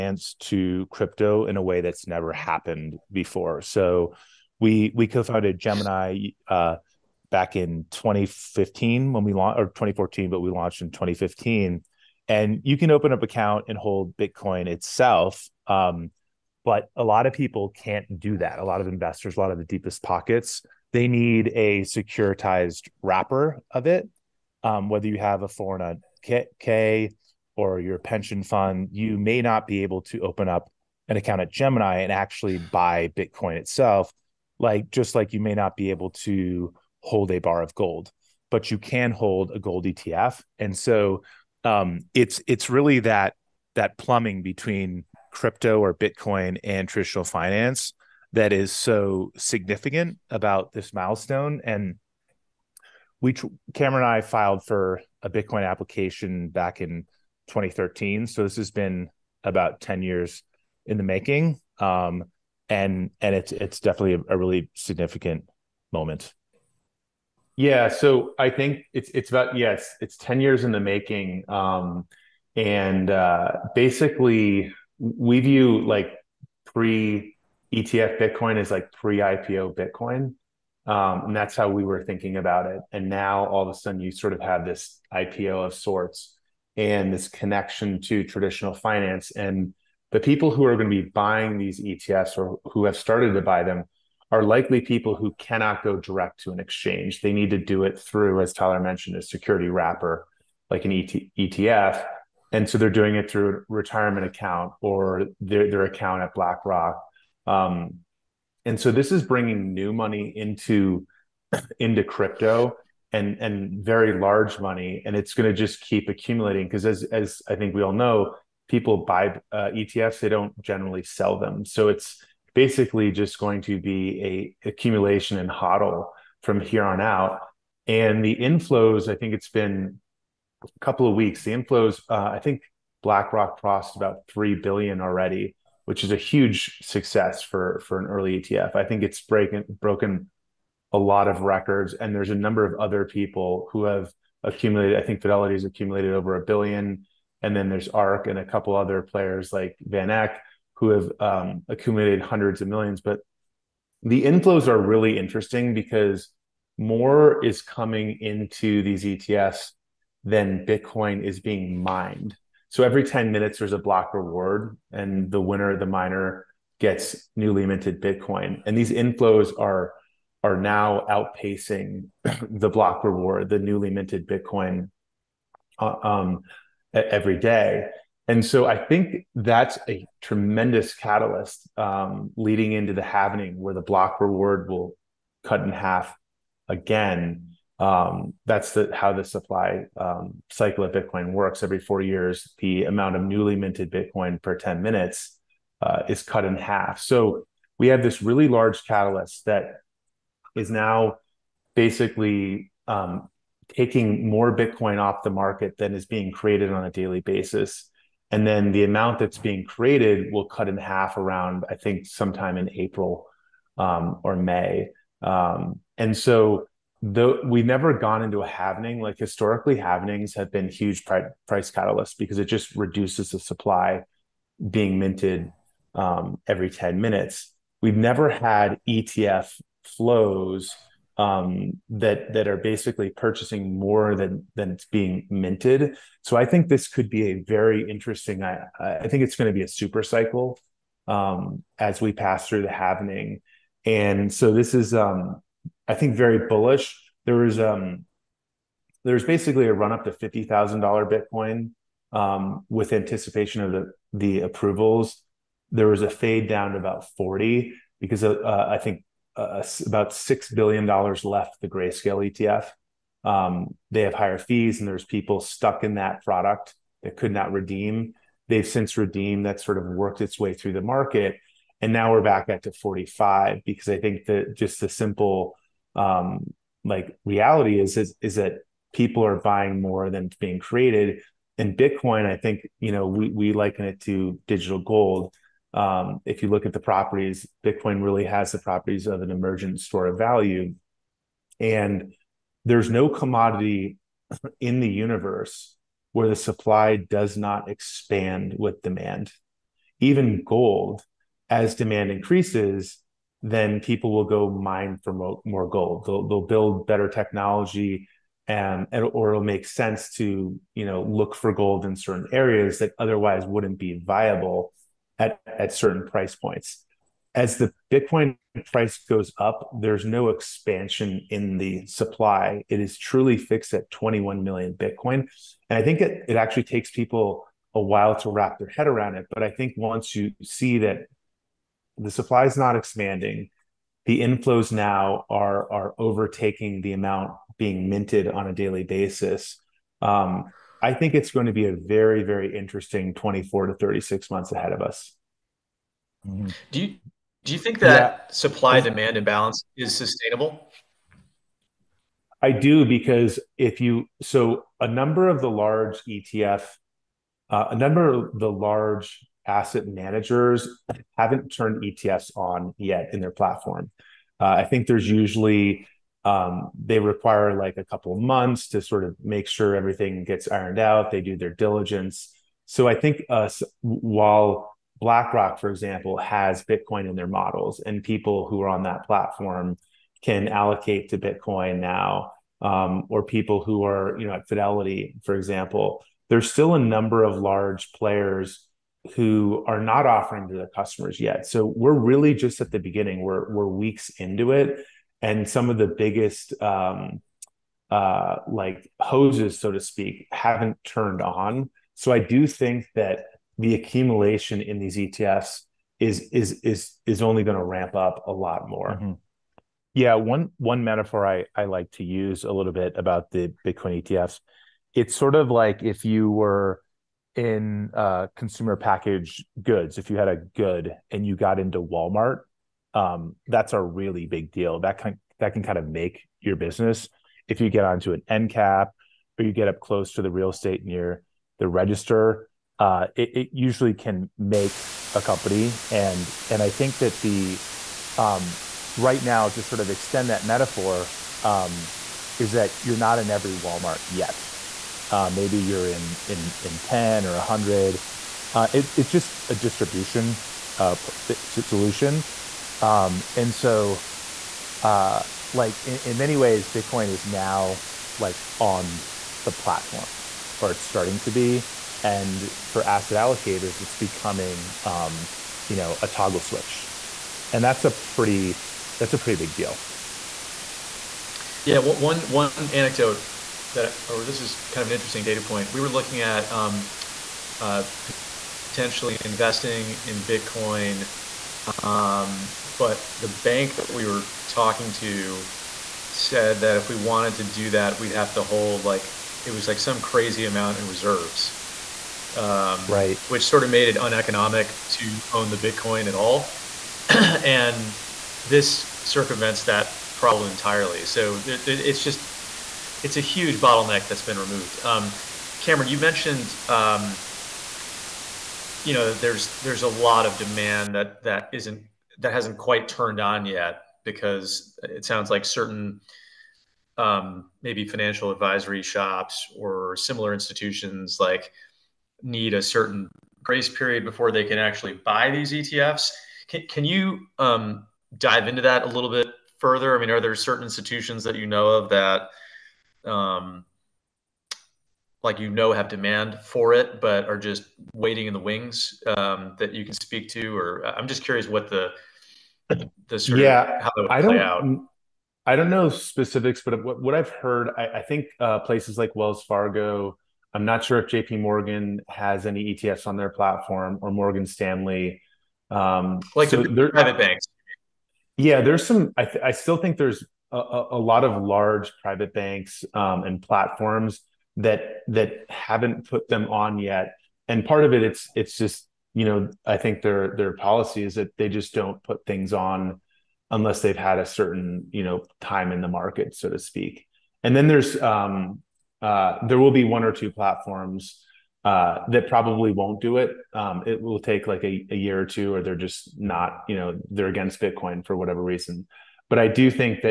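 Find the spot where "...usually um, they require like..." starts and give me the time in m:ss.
6:05.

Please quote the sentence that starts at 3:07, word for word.
Um, that's the, how the supply um, cycle of Bitcoin works.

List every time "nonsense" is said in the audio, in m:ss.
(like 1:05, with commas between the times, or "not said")
not said.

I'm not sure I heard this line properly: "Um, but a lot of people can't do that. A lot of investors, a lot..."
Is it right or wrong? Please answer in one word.
right.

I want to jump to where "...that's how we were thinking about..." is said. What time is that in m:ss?
1:21.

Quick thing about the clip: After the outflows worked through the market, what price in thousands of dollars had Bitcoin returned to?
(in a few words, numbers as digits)
45.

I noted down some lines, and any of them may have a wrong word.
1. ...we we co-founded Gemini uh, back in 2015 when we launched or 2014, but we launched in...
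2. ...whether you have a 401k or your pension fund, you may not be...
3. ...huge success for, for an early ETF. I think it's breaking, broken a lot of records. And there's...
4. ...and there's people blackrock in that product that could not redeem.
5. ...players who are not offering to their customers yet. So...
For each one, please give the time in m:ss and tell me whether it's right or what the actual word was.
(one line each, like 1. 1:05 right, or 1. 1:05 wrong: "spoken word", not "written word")
1. 0:04 right
2. 0:24 right
3. 2:16 right
4. 4:24 wrong: "stuck", not "blackrock"
5. 6:27 right.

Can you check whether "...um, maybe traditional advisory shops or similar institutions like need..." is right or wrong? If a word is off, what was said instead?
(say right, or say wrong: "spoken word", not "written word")
wrong: "financial", not "traditional".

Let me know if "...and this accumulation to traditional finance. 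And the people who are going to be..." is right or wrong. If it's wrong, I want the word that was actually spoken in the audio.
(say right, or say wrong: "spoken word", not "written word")
wrong: "connection", not "accumulation".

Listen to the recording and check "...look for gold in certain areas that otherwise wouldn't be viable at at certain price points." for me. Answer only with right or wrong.
right.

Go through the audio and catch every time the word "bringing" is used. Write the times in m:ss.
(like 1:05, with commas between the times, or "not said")
1:49.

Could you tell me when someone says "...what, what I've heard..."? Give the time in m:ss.
9:06.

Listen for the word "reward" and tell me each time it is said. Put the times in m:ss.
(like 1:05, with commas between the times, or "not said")
2:44, 2:53, 3:04.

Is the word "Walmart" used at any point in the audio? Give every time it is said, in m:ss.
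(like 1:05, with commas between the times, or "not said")
7:01, 7:23.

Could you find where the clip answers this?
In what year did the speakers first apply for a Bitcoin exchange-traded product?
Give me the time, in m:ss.
0:57.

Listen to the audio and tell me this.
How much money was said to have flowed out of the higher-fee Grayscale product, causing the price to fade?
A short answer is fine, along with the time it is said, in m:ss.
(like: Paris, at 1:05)
about $6 billion, at 4:19.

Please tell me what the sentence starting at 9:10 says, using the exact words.
I'm not sure if JP Morgan has any ETFs on their platform or Morgan Stanley.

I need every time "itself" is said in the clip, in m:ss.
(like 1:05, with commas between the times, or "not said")
0:14, 0:33.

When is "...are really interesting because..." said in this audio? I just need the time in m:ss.
2:34.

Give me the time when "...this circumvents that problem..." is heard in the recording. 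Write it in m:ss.
8:18.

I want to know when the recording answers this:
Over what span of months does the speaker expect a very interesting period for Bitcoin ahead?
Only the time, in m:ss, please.
5:43.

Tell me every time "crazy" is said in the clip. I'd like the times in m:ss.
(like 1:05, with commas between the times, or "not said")
8:10.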